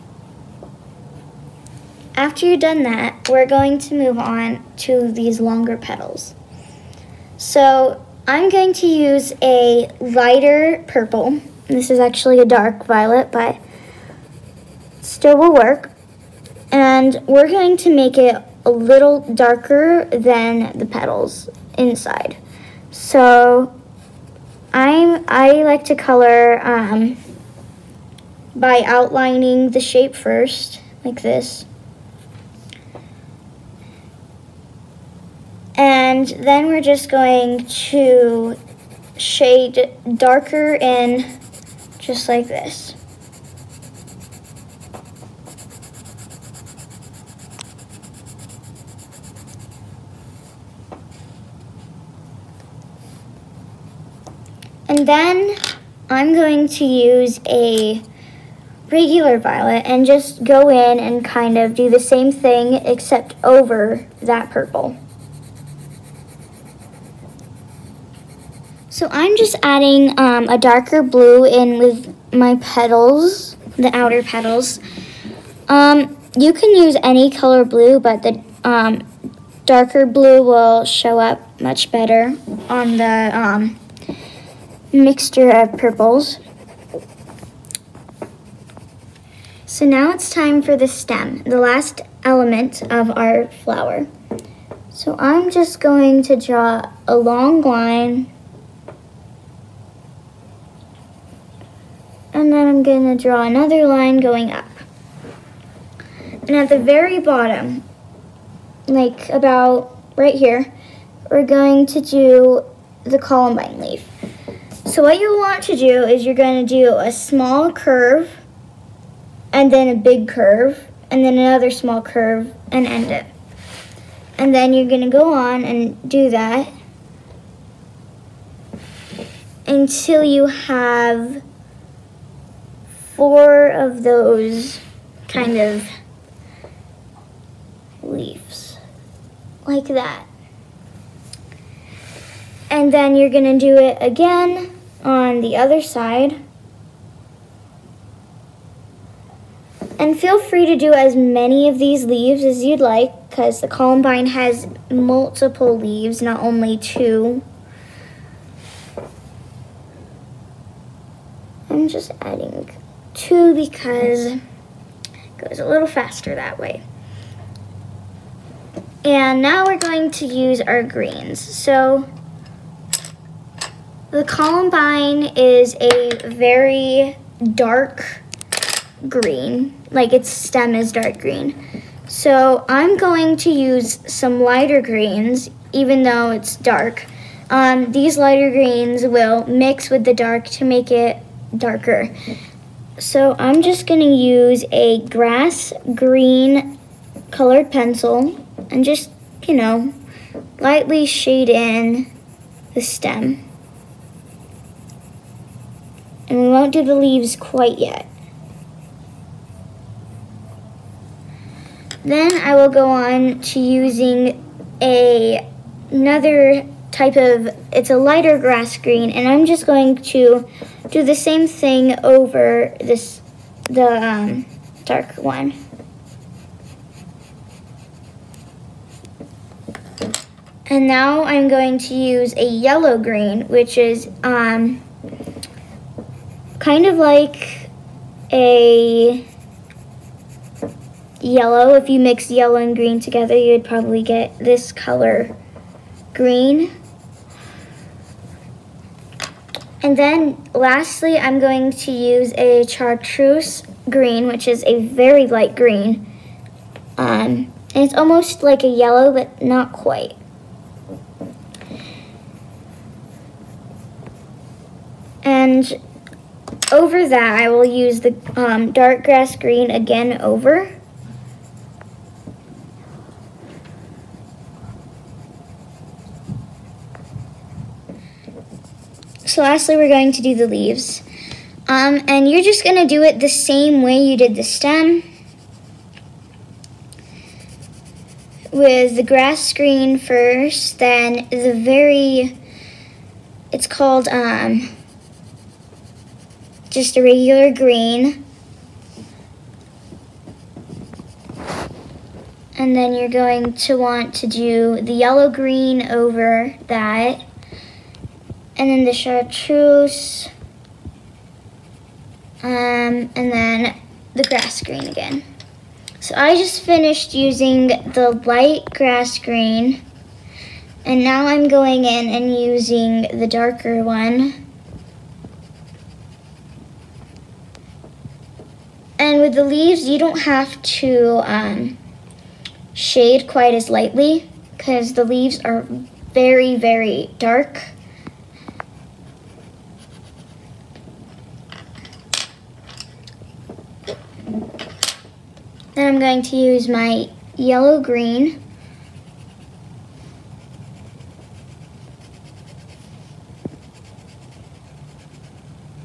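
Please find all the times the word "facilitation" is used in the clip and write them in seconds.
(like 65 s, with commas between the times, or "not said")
not said.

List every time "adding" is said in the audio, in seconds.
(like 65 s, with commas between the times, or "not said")
69 s, 162 s.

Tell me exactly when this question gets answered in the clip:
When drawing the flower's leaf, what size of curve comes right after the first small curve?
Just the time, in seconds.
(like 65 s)
119 s.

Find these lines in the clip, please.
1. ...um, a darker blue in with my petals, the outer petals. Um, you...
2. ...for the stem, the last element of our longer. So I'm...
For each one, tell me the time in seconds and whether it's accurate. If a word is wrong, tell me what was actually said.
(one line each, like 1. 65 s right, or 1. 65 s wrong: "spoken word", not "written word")
1. 70 s right
2. 90 s wrong: "flower", not "longer".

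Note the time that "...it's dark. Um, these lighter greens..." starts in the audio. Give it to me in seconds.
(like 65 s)
186 s.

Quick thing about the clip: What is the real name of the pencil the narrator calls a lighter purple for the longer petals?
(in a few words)
Dark violet.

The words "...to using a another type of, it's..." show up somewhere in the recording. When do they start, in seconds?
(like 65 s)
213 s.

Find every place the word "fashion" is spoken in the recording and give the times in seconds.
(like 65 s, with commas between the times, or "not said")
not said.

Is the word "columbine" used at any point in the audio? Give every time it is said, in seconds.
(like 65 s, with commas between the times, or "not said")
113 s, 153 s, 174 s.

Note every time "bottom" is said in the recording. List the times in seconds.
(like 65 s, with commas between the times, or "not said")
107 s.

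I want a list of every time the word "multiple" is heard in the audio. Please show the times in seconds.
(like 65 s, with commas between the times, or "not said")
154 s.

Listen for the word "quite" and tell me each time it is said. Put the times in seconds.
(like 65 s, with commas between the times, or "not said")
207 s, 259 s, 333 s.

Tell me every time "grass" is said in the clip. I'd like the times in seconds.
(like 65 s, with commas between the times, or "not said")
195 s, 218 s, 269 s, 289 s, 314 s, 318 s.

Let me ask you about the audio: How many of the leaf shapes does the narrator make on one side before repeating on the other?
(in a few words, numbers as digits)
4.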